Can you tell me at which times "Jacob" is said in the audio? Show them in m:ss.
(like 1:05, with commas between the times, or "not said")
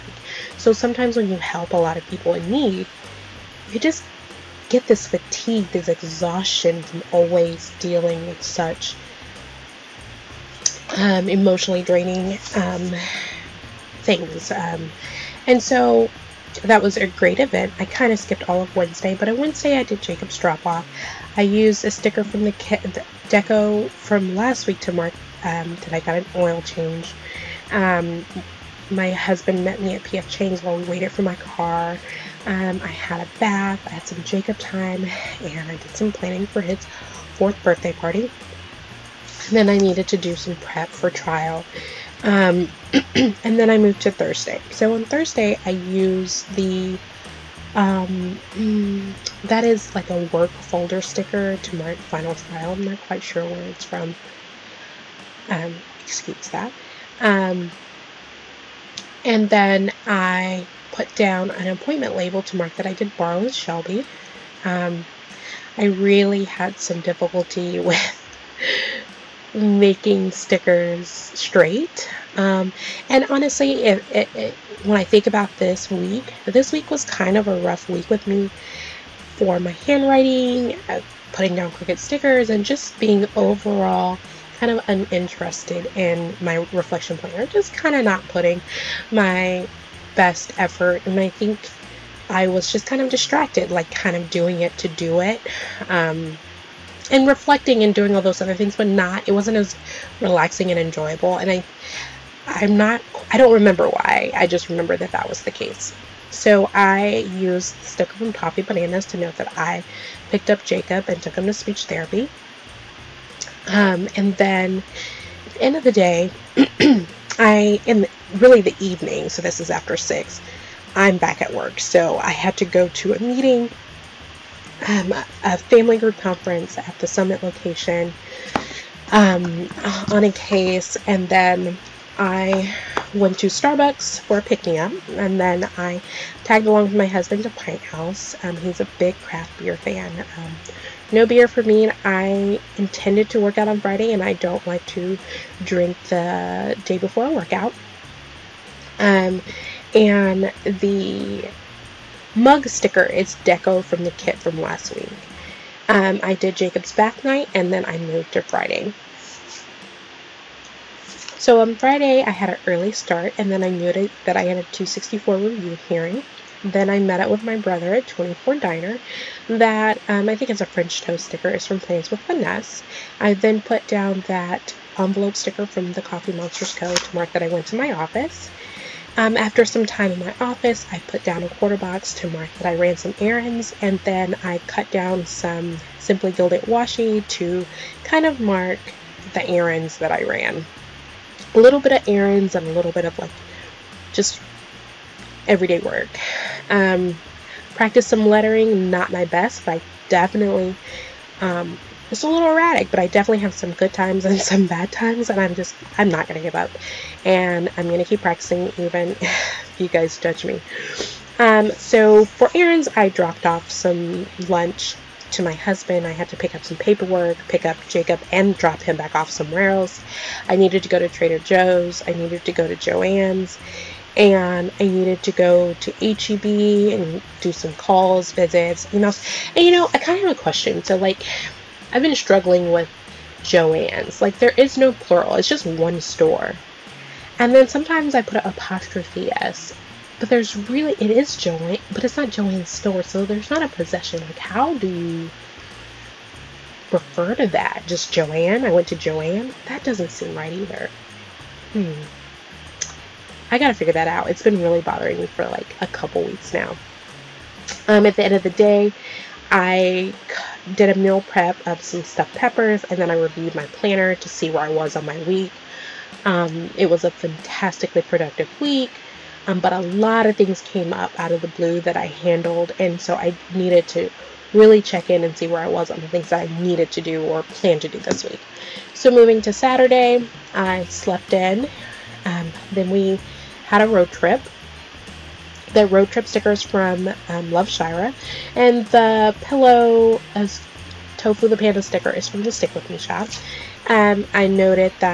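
0:20, 0:34, 1:50, 2:36, 3:37.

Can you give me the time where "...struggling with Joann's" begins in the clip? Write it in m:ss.
3:52.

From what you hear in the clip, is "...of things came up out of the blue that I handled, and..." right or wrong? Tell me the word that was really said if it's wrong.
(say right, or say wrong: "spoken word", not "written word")
right.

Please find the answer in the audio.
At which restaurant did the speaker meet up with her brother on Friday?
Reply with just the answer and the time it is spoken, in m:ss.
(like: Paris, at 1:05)
24 Diner, at 2:48.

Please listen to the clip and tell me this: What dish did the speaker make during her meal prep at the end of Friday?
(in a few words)
Stuffed peppers.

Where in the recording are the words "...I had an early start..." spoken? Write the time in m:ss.
2:42.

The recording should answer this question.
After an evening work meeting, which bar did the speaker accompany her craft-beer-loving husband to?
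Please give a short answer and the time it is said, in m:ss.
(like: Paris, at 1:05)
Pint House, at 2:17.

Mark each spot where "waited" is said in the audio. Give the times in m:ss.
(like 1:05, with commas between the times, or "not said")
0:30.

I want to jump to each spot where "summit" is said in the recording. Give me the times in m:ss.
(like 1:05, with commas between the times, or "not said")
2:07.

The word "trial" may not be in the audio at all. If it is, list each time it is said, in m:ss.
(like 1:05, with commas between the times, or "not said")
0:41, 0:52.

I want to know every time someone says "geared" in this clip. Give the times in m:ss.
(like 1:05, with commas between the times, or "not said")
not said.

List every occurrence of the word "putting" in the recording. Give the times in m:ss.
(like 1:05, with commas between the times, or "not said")
1:21, 1:28.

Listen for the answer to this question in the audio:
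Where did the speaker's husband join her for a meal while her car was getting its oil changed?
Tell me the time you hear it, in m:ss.
0:30.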